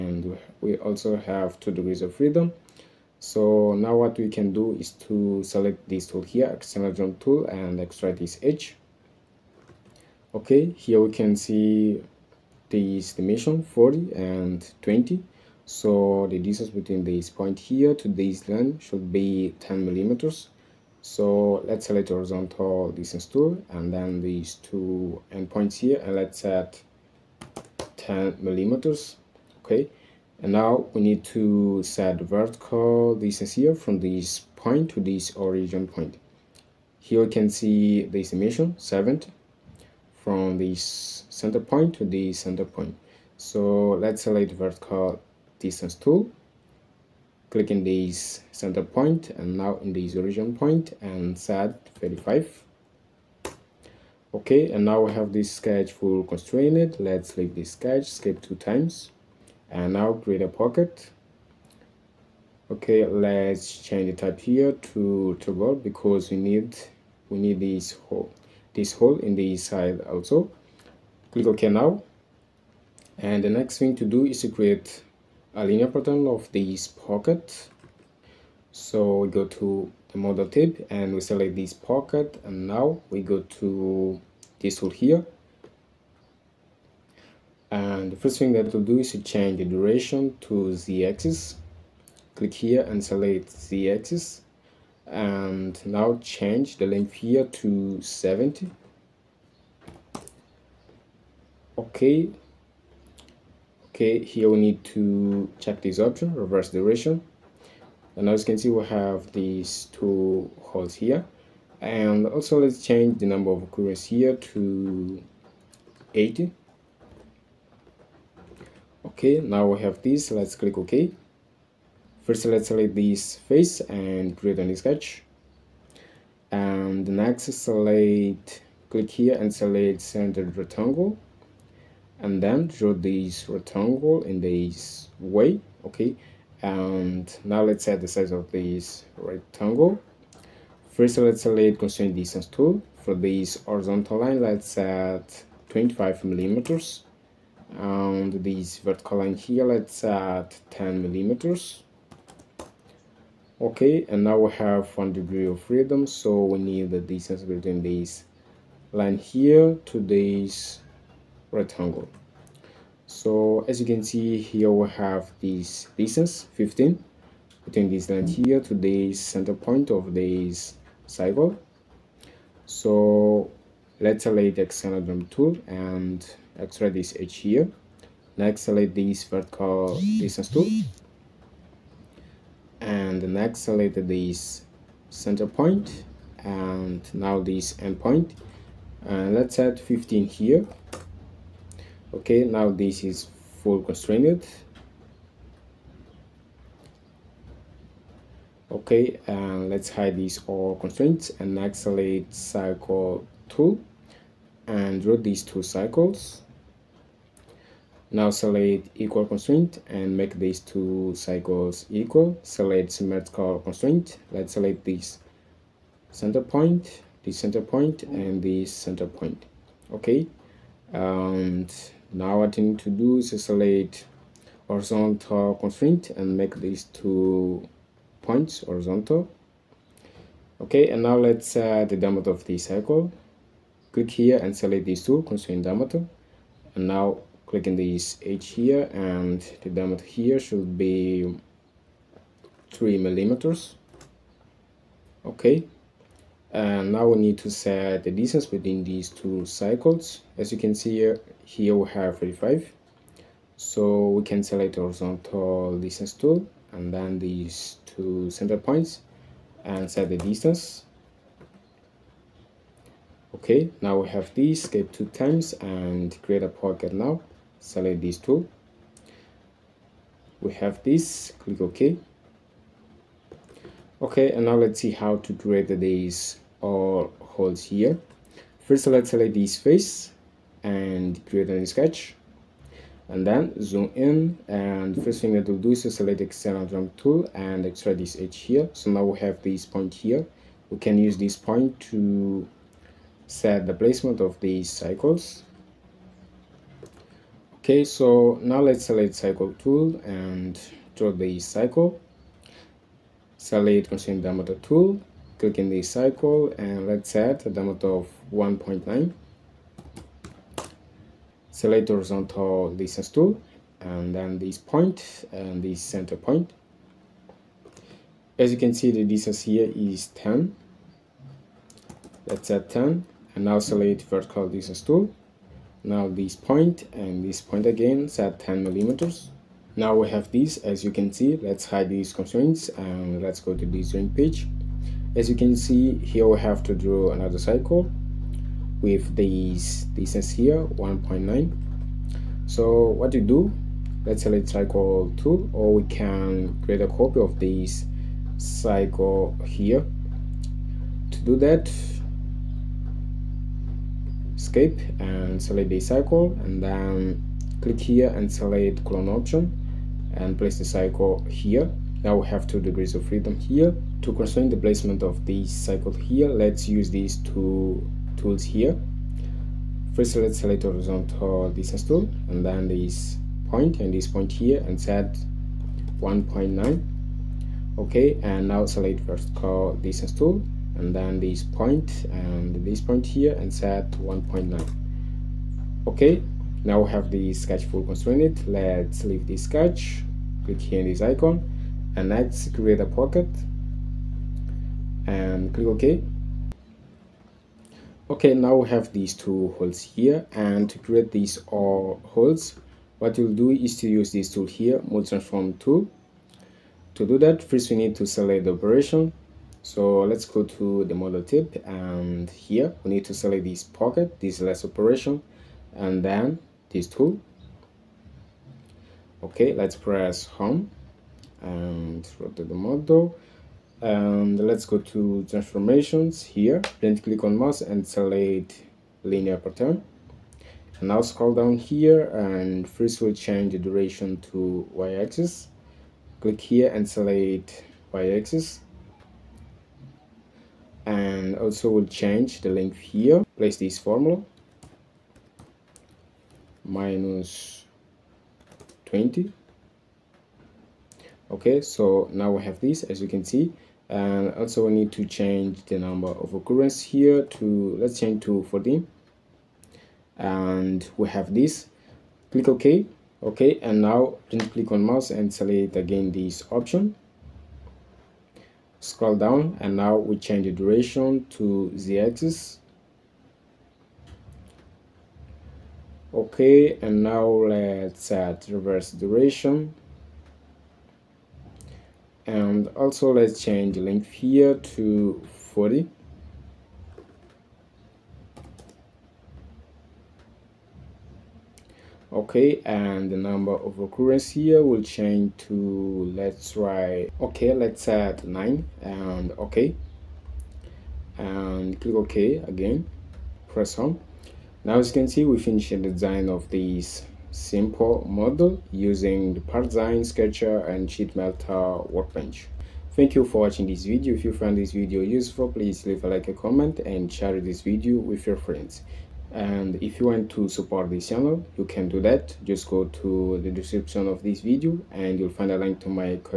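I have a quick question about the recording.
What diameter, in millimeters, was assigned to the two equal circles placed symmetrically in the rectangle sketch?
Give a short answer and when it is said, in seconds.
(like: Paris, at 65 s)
3, at 242 s.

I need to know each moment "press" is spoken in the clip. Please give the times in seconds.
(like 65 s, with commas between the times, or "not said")
419 s, 503 s.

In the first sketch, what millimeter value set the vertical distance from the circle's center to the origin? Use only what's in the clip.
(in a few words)
35.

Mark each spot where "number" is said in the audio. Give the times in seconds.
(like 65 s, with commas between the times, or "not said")
113 s, 455 s, 493 s.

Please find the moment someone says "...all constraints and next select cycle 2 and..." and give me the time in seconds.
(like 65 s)
200 s.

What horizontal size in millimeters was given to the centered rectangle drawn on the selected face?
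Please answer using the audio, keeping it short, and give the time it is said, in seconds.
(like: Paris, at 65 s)
25, at 145 s.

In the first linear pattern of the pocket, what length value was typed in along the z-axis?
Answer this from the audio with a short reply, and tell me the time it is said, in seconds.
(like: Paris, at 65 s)
70, at 96 s.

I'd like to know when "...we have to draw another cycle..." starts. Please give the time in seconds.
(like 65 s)
336 s.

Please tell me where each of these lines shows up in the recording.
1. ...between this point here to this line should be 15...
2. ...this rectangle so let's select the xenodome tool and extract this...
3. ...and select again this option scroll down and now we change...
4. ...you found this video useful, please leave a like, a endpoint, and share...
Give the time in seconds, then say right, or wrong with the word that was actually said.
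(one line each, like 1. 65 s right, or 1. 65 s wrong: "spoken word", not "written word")
1. 16 s wrong: "10", not "15"
2. 170 s wrong: "cycle", not "rectangle"
3. 465 s right
4. 514 s wrong: "comment", not "endpoint".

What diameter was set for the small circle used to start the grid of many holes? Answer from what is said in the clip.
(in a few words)
1.9.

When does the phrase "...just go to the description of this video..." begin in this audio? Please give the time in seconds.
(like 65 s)
522 s.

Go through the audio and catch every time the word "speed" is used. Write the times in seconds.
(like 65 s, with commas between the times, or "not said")
not said.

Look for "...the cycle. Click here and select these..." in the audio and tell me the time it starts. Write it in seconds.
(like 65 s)
232 s.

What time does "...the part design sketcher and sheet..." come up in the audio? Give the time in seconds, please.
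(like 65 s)
509 s.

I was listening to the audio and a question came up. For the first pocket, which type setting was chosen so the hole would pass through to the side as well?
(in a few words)
toggle.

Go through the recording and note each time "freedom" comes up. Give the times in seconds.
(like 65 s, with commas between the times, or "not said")
2 s, 155 s, 363 s.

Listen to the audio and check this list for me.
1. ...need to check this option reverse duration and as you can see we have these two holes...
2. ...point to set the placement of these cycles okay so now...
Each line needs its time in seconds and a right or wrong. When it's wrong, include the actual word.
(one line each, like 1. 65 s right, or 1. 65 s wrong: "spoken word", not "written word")
1. 104 s right
2. 291 s right.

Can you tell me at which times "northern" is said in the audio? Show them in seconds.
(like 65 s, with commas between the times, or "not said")
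not said.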